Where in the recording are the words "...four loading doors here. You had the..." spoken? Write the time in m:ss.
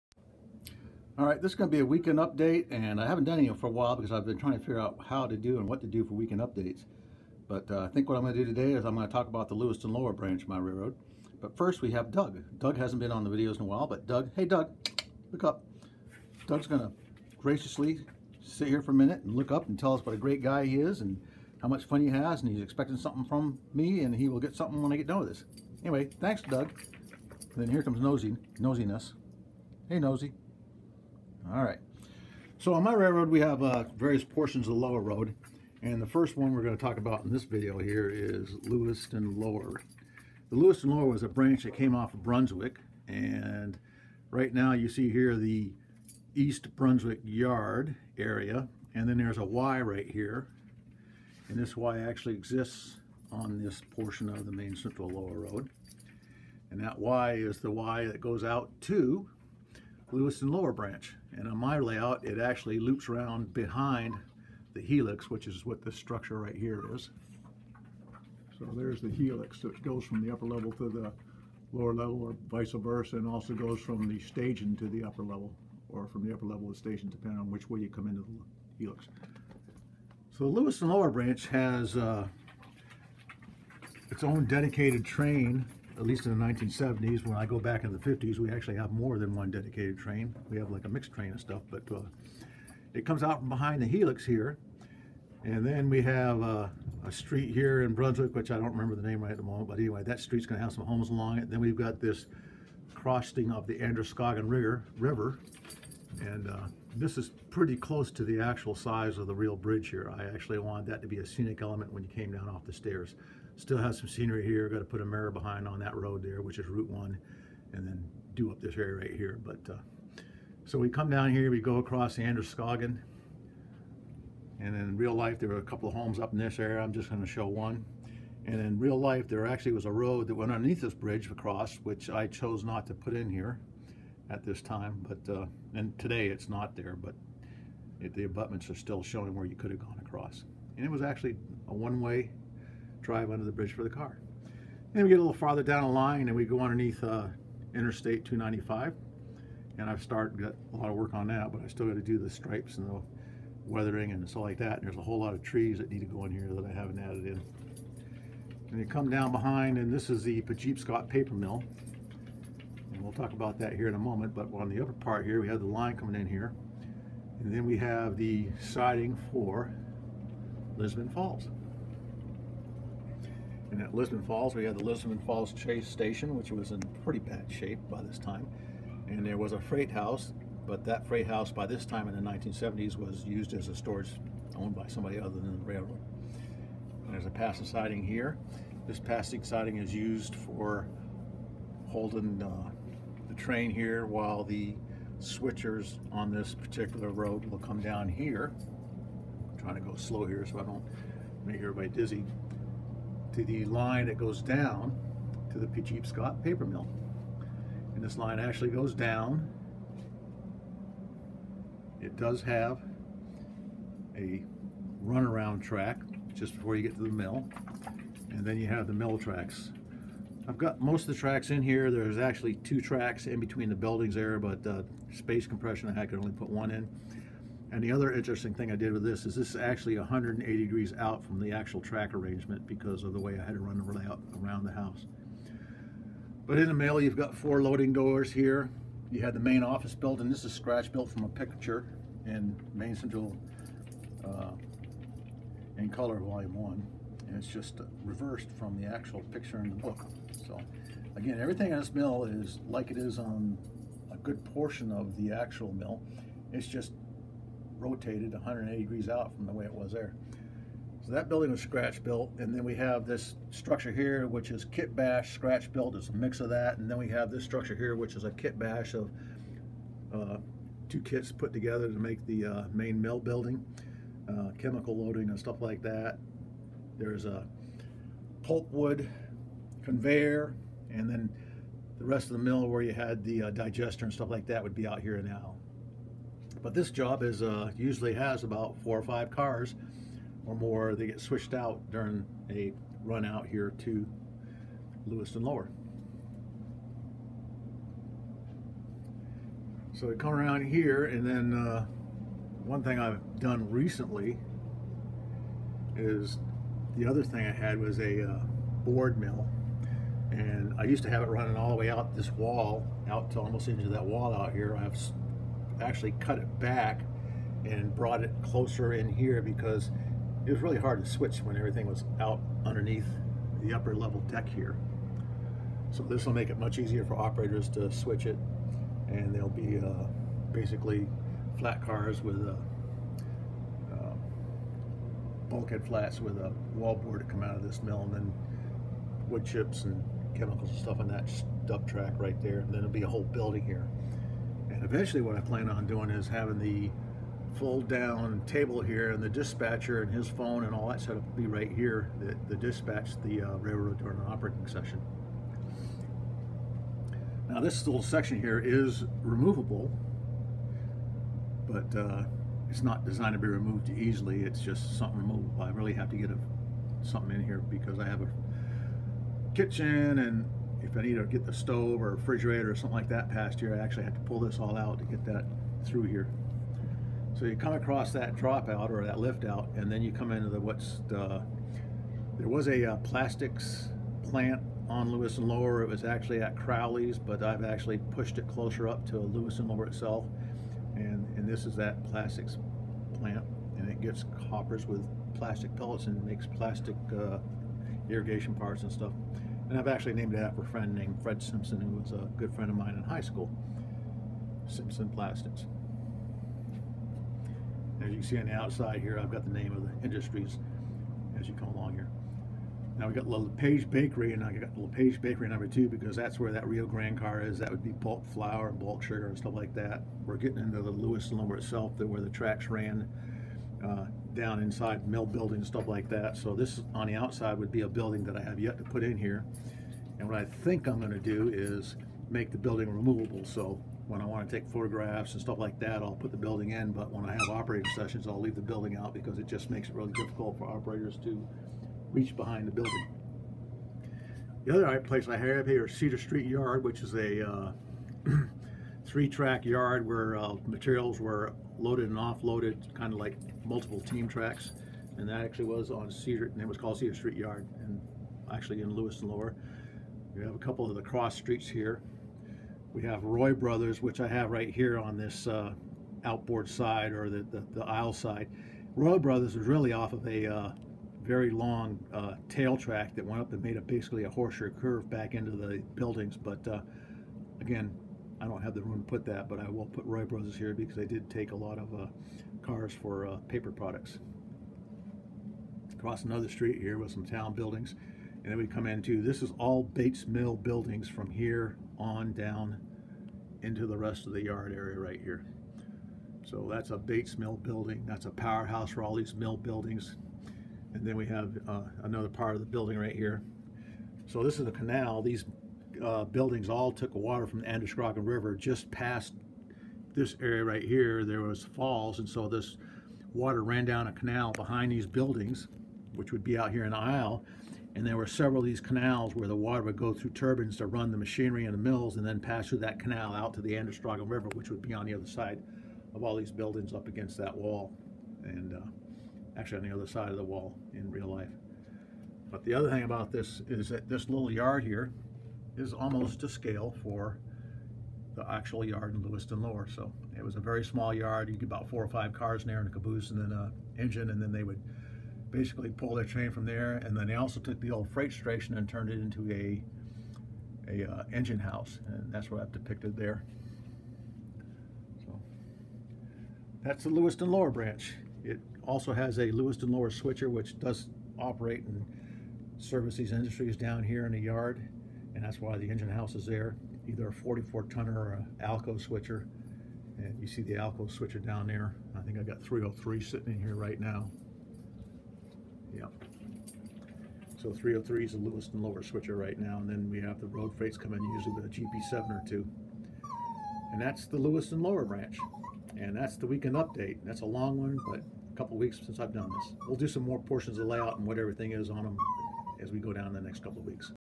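3:57.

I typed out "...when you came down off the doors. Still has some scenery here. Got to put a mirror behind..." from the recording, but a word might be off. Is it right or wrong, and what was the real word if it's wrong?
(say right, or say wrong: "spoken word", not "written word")
wrong: "stairs", not "doors".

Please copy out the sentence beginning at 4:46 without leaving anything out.
But this job is uh, usually has about four or five cars or more.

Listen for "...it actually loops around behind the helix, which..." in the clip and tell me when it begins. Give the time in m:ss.
1:02.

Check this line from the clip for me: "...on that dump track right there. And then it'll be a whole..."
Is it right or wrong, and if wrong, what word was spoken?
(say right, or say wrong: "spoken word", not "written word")
right.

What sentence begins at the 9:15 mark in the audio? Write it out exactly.
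So that's the Lewiston Lower branch.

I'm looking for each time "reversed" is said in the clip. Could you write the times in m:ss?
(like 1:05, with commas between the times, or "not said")
4:08.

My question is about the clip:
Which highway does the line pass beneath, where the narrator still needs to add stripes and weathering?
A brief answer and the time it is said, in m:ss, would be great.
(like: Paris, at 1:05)
Interstate 295, at 2:27.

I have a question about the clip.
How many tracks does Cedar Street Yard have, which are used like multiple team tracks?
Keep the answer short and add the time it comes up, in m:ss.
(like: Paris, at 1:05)
3, at 7:29.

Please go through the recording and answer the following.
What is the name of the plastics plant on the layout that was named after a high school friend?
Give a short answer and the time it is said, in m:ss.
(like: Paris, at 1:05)
Simpson Plastics, at 6:44.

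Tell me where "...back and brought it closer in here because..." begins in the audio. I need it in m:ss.
5:16.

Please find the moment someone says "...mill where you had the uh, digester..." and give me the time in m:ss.
4:42.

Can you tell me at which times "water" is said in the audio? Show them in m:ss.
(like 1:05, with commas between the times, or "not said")
8:27, 8:33, 8:39.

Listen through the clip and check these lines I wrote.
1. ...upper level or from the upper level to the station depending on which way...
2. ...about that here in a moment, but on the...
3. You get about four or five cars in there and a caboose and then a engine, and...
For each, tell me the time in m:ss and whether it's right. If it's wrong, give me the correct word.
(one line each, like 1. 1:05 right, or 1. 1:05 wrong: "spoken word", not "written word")
1. 1:15 right
2. 2:43 right
3. 9:01 right.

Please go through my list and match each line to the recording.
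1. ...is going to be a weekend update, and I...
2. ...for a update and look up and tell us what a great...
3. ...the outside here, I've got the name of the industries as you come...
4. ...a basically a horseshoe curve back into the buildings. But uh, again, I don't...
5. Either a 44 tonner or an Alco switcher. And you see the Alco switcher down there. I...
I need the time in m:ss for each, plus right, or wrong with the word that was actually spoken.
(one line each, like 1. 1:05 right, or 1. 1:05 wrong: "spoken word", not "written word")
1. 0:01 right
2. 0:18 wrong: "minute", not "update"
3. 6:48 right
4. 7:53 right
5. 9:27 right.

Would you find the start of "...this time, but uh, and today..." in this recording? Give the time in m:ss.
2:14.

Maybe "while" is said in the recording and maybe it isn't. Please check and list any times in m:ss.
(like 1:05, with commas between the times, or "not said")
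0:03, 0:13, 3:14.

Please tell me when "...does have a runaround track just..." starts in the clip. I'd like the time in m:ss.
3:32.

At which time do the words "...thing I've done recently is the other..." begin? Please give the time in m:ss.
5:02.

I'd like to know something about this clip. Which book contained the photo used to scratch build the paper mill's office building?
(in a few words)
Maine Central in Color, Volume 1.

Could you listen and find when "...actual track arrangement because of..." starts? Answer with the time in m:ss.
3:51.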